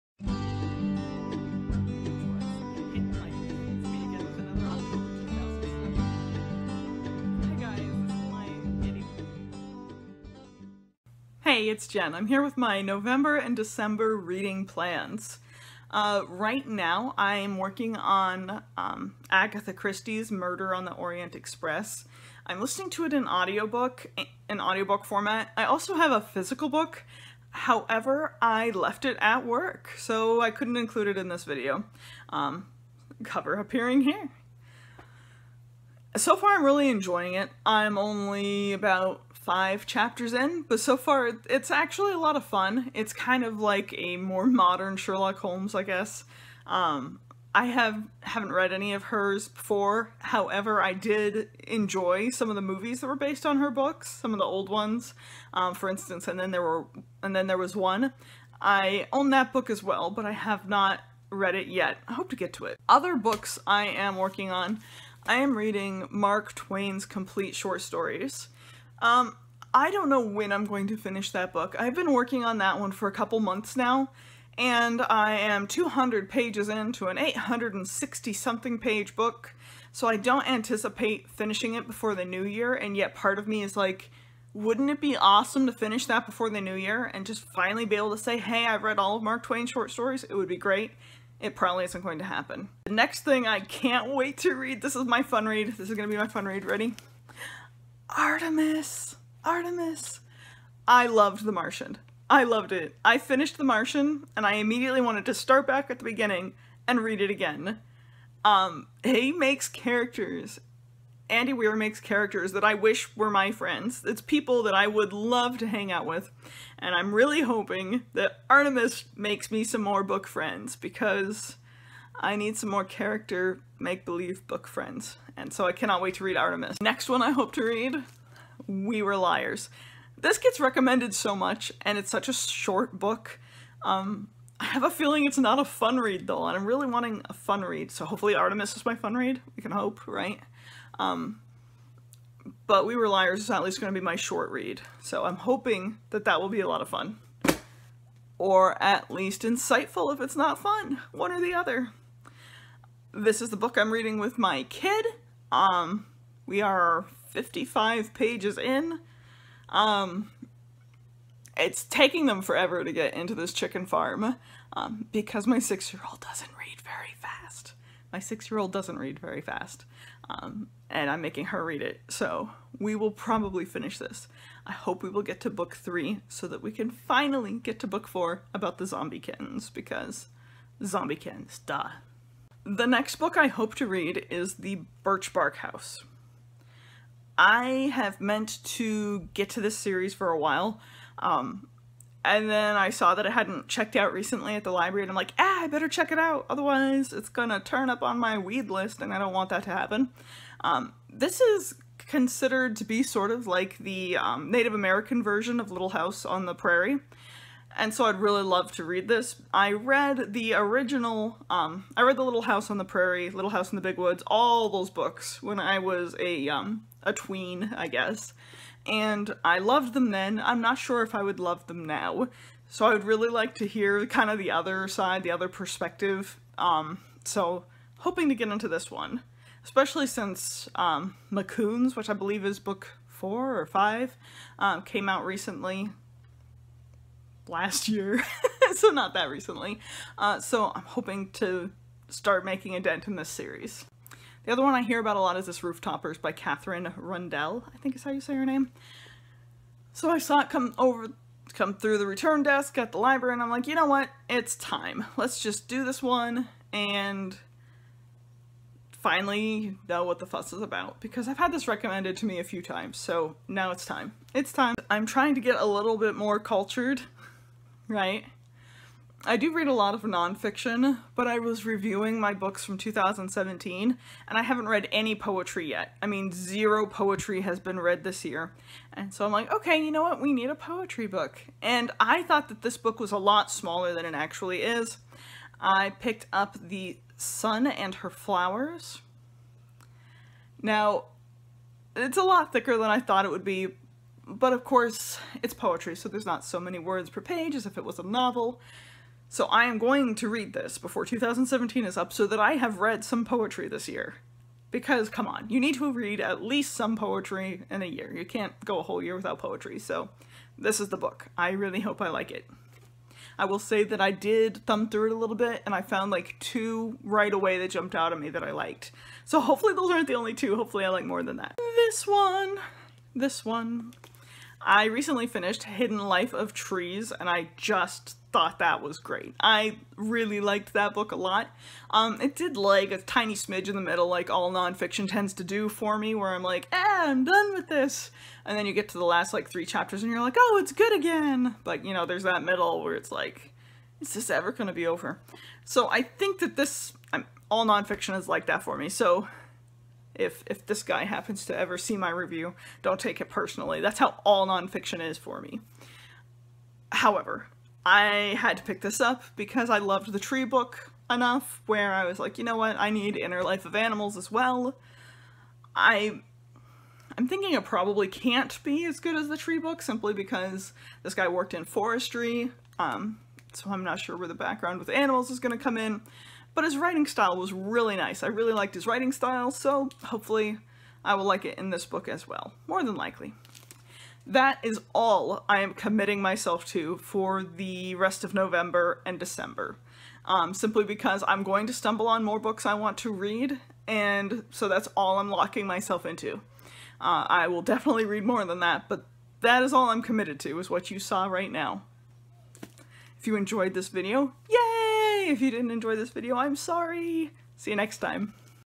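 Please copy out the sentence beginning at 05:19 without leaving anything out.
So hopefully those aren't the only two.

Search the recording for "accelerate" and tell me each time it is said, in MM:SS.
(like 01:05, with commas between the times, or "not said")
not said.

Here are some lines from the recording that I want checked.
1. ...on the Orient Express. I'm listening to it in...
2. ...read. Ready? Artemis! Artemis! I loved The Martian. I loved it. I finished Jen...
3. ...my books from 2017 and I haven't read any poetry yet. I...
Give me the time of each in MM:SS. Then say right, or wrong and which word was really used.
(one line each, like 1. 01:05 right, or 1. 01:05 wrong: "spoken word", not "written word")
1. 00:20 right
2. 01:36 wrong: "The", not "Jen"
3. 04:32 right.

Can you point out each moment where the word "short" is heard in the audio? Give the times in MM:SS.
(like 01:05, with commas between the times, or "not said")
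01:07, 01:29, 02:12, 02:24.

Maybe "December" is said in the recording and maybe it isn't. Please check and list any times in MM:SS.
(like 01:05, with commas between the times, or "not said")
00:13, 06:29.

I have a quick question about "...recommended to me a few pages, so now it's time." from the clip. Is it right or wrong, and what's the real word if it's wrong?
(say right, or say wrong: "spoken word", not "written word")
wrong: "times", not "pages".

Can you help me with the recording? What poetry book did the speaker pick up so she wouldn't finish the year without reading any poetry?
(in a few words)
The Sun and Her Flowers.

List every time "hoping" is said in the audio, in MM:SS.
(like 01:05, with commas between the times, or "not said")
01:57, 02:25, 03:47, 04:00.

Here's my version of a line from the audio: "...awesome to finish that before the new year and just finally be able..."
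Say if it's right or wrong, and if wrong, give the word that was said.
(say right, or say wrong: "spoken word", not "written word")
right.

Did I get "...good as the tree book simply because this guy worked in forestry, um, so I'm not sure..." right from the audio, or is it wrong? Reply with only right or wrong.
right.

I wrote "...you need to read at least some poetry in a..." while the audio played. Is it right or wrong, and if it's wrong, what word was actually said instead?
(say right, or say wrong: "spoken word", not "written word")
right.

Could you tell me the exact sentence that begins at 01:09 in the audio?
Um, I don't know when I'm going to finish that book.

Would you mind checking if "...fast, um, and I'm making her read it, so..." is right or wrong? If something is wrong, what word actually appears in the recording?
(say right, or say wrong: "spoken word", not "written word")
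right.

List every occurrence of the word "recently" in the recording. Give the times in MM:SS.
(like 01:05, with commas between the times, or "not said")
03:14, 03:55, 03:59, 05:24.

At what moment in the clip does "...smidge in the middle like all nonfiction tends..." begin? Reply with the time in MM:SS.
05:33.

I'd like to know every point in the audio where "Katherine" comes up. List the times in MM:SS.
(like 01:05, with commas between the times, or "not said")
04:06.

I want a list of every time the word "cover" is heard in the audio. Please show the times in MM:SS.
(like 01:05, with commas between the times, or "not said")
00:33.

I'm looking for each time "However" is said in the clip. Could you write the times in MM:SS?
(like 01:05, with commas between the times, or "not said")
00:27, 00:50, 05:56.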